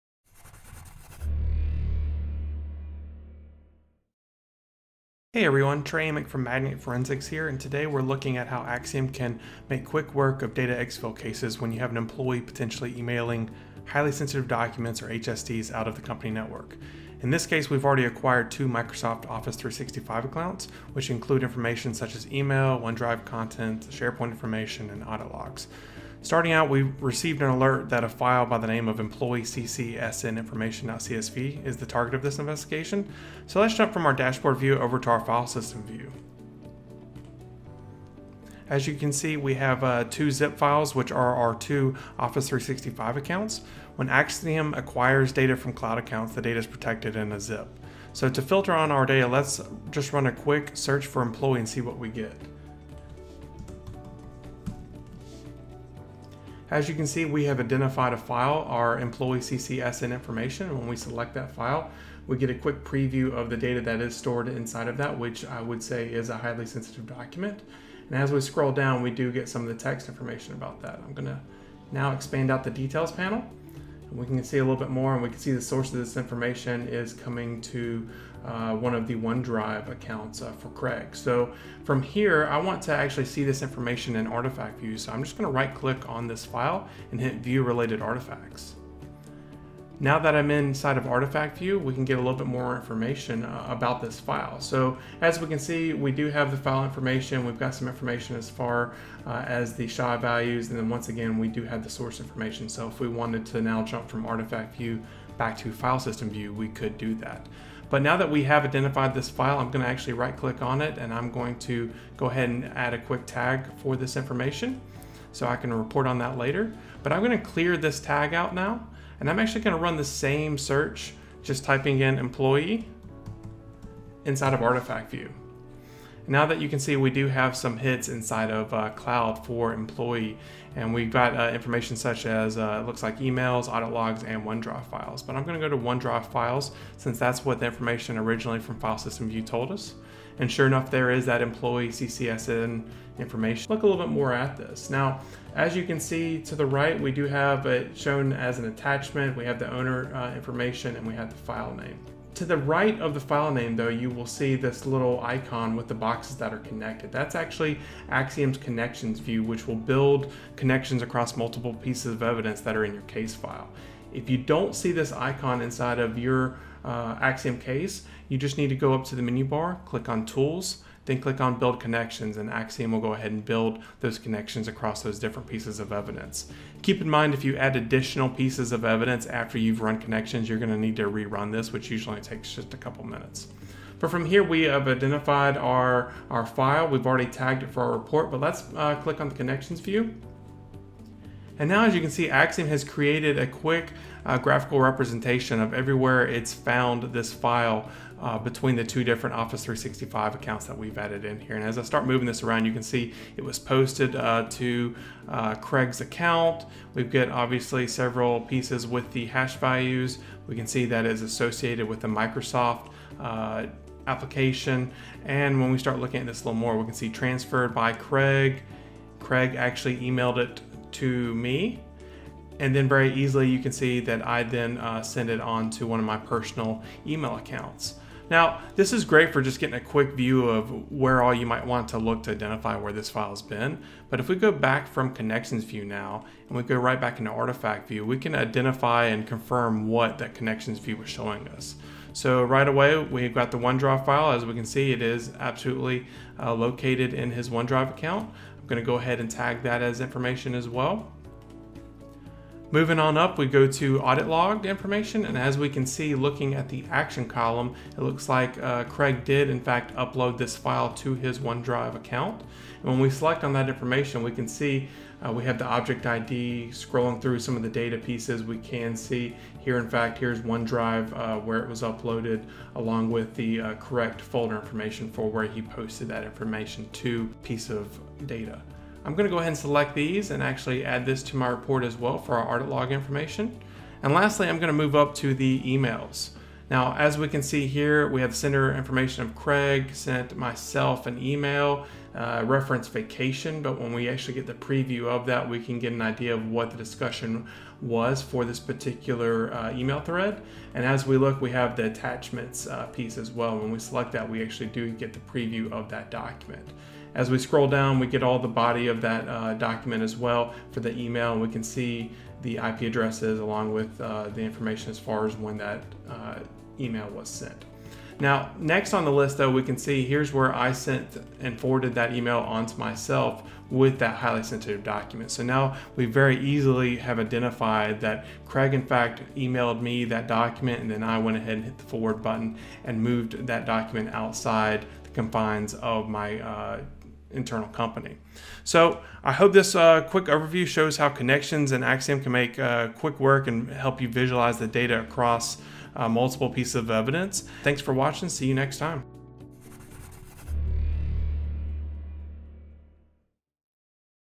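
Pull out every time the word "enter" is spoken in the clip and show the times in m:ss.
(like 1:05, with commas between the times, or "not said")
not said.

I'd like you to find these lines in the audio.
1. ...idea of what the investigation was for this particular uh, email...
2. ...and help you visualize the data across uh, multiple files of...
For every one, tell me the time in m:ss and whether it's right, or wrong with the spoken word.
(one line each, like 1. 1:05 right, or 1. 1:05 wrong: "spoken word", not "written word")
1. 4:56 wrong: "discussion", not "investigation"
2. 5:43 wrong: "pieces", not "files".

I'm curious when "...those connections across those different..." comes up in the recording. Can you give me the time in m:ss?
2:54.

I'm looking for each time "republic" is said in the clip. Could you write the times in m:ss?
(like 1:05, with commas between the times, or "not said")
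not said.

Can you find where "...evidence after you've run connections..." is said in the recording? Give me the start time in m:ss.
2:58.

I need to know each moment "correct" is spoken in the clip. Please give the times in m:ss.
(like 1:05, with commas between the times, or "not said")
4:33.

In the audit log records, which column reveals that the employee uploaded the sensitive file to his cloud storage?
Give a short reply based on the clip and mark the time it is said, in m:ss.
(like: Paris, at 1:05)
action column, at 4:16.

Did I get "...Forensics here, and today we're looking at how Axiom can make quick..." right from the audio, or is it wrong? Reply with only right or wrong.
right.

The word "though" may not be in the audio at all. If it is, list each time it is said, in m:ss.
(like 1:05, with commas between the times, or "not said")
2:33, 5:19.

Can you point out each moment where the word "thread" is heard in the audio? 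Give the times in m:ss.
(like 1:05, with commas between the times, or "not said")
4:59.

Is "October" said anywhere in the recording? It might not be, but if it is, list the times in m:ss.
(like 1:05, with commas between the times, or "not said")
not said.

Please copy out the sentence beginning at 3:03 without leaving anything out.
But from here, we have identified our, our file.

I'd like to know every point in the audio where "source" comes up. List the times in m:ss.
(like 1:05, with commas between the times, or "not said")
1:15, 1:41.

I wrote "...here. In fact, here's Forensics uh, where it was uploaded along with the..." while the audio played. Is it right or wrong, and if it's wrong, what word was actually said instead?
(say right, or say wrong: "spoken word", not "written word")
wrong: "OneDrive", not "Forensics".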